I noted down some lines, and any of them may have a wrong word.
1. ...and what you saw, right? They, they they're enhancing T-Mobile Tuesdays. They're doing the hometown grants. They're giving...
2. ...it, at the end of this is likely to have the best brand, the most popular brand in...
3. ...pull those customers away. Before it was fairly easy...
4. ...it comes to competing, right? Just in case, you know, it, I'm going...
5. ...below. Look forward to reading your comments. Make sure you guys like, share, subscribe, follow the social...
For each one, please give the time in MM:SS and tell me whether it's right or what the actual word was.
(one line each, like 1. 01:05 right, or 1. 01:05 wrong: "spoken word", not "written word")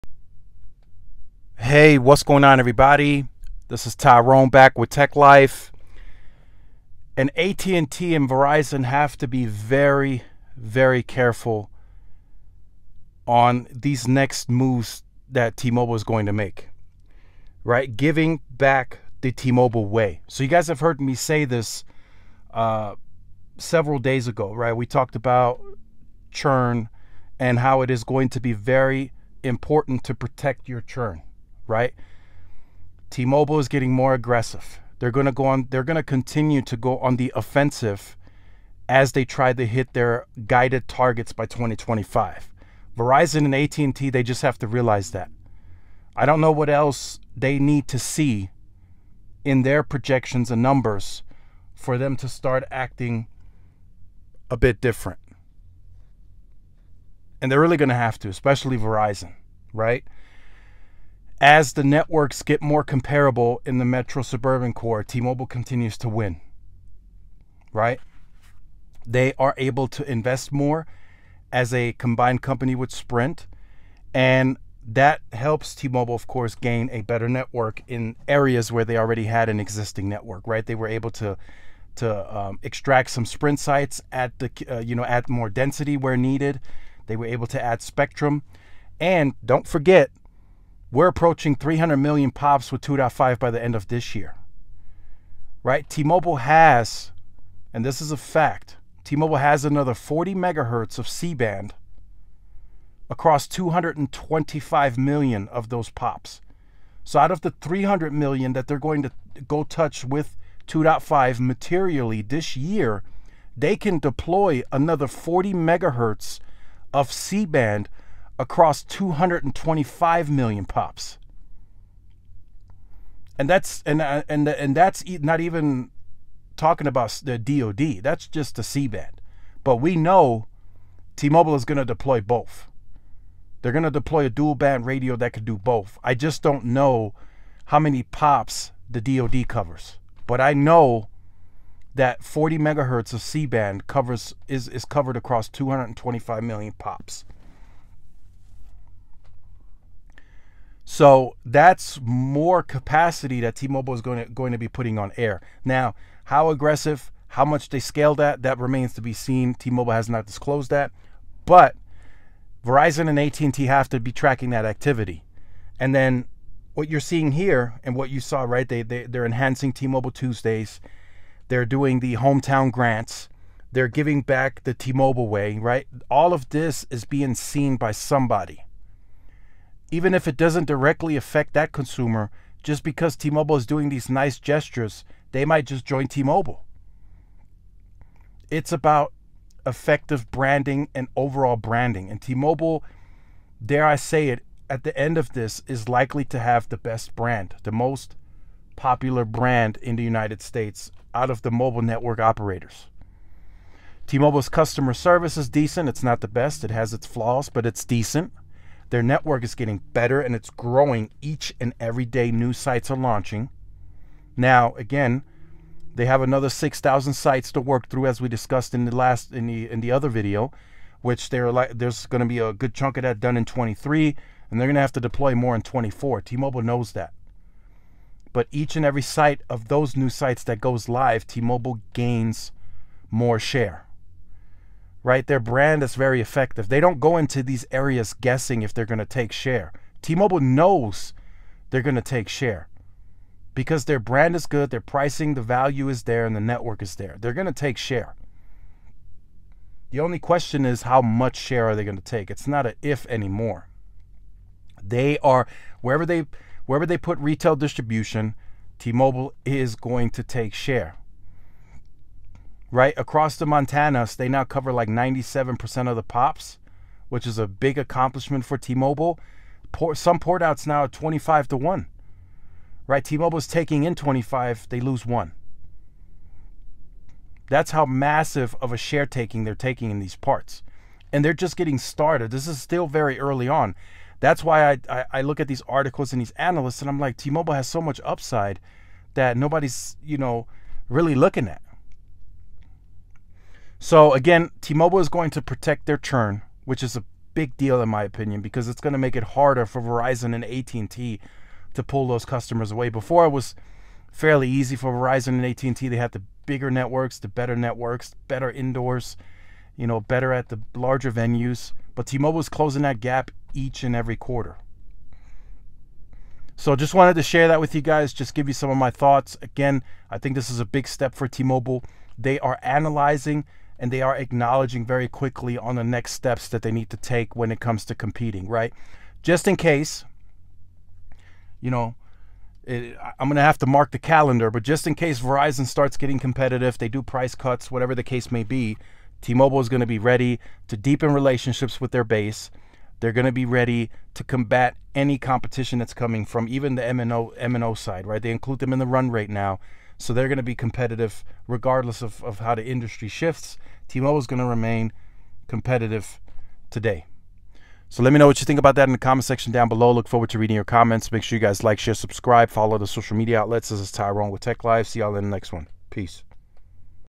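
1. 02:47 right
2. 03:14 right
3. 05:01 right
4. 05:27 right
5. 05:59 right.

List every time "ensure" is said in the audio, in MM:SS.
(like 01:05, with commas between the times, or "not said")
not said.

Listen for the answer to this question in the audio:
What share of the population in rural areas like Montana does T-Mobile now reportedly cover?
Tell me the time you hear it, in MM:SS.
04:24.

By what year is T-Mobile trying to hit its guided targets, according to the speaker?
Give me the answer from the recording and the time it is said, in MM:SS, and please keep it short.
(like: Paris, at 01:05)
2025, at 00:41.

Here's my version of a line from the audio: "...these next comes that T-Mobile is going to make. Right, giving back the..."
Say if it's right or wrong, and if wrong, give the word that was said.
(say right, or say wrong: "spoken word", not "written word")
wrong: "moves", not "comes".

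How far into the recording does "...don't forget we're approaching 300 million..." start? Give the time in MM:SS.
01:29.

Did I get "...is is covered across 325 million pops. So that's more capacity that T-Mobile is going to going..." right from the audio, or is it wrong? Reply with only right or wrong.
wrong.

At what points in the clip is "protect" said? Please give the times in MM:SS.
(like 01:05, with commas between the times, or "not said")
00:30, 04:55.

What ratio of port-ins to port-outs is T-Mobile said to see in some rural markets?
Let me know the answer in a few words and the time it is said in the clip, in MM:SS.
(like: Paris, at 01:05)
25 to 1, at 04:30.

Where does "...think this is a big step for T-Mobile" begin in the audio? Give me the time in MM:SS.
05:20.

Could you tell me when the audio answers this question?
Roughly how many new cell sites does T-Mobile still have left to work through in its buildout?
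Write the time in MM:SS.
03:36.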